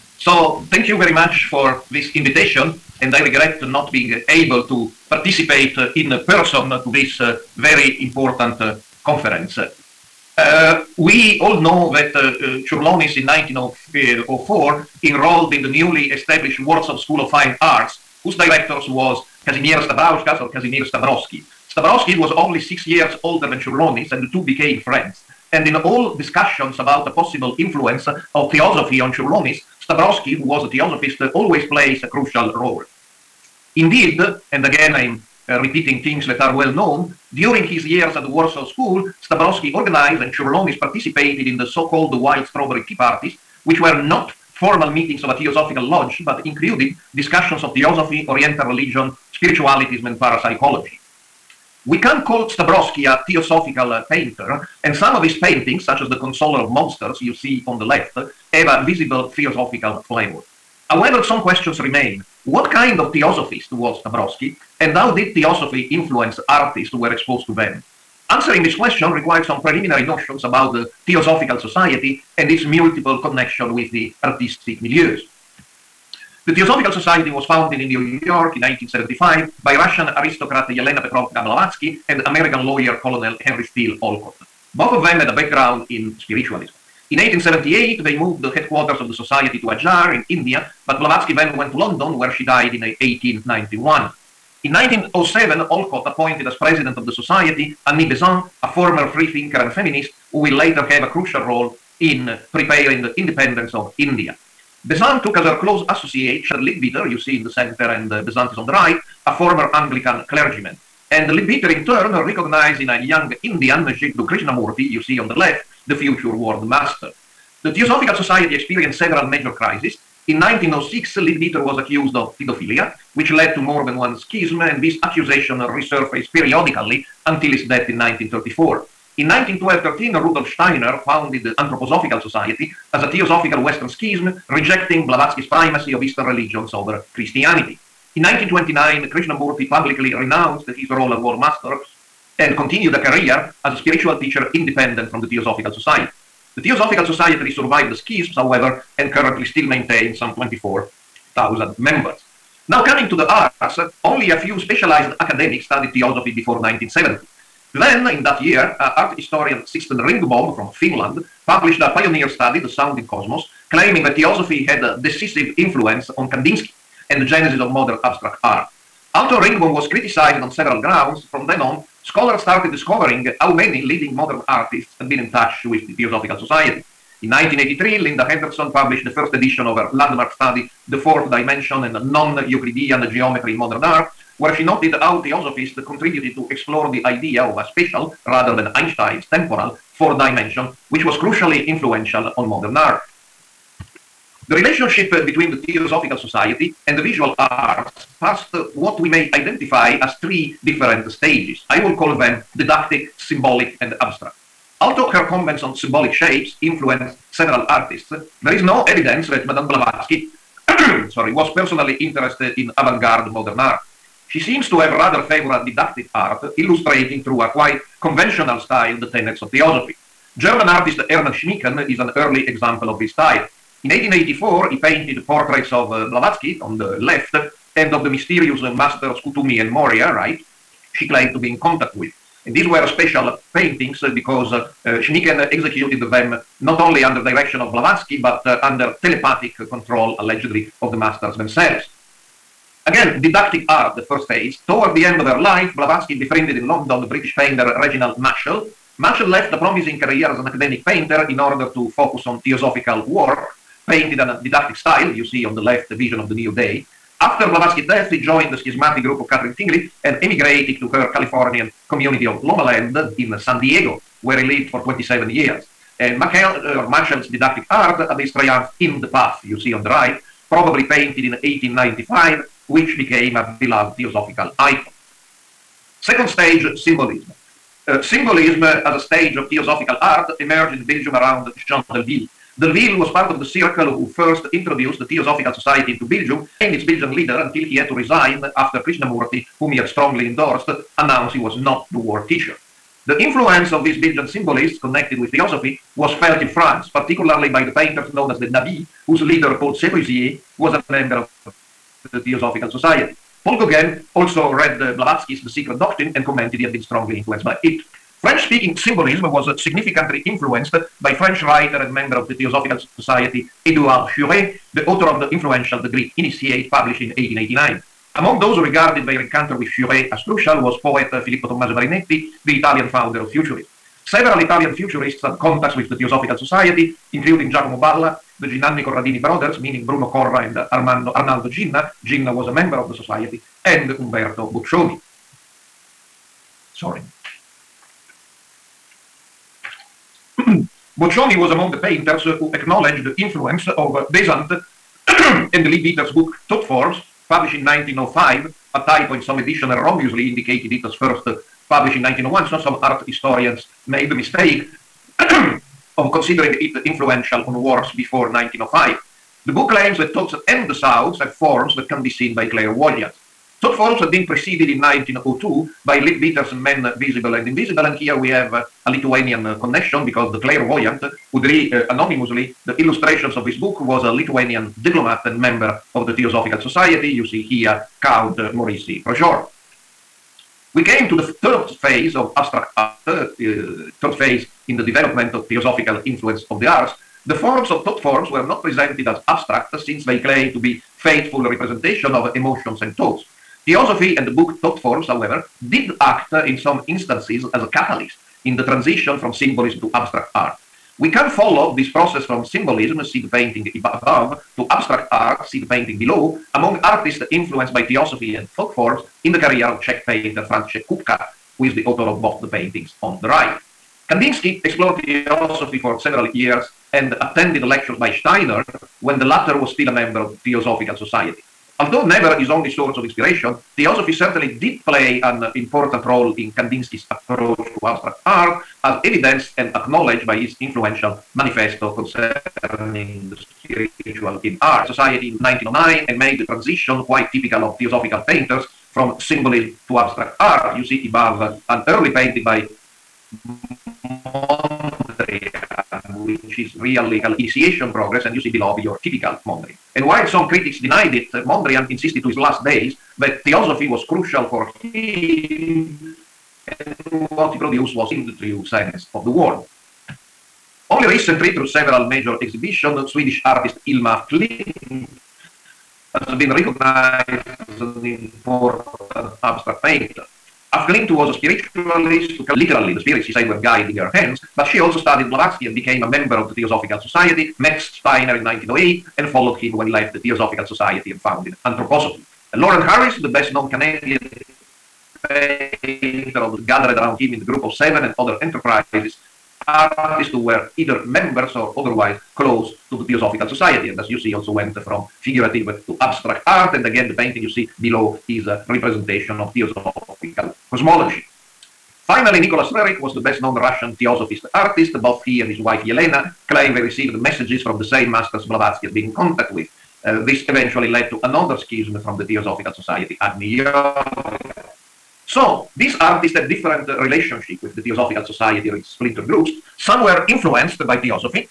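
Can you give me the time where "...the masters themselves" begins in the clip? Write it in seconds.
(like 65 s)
240 s.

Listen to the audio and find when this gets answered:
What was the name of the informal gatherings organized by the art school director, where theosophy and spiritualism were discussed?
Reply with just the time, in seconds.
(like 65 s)
42 s.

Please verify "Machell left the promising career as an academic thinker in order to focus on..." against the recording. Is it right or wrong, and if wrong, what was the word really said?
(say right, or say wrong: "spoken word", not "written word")
wrong: "painter", not "thinker".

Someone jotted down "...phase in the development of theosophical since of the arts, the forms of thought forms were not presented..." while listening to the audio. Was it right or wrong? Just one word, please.
wrong.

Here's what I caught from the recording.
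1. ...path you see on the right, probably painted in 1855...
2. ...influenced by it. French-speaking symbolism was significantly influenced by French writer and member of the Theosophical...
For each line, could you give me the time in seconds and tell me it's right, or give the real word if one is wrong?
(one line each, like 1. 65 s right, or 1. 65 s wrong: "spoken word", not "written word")
1. 269 s wrong: "1895", not "1855"
2. 307 s right.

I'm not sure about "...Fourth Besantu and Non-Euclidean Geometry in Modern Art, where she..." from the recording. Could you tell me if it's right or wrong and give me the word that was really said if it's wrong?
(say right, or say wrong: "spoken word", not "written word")
wrong: "Dimension", not "Besantu".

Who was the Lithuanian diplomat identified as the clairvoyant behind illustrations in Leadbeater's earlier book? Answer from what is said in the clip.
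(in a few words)
Count Maurice Prozor.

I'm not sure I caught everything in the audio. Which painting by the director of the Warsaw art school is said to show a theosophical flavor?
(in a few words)
The Consoler of Monsters.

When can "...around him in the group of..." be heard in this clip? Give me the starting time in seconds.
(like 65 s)
486 s.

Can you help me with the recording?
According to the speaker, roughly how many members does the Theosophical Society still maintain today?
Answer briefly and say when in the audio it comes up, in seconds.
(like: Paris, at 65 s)
24,000, at 150 s.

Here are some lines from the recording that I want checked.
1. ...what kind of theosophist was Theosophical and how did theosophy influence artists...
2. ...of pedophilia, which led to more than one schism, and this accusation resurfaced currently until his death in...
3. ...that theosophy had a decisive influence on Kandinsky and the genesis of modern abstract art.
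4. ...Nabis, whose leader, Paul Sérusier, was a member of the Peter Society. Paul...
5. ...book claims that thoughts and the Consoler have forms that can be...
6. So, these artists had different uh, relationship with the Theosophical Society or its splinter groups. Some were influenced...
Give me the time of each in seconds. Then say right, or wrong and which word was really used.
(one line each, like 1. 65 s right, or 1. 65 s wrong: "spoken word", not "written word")
1. 62 s wrong: "Stabrowski", not "Theosophical"
2. 122 s wrong: "periodically", not "currently"
3. 164 s right
4. 298 s wrong: "Theosophical", not "Peter"
5. 359 s wrong: "Souths", not "Consoler"
6. 515 s right.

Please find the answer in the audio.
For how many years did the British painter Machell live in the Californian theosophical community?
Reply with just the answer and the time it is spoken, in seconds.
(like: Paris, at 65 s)
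27, at 264 s.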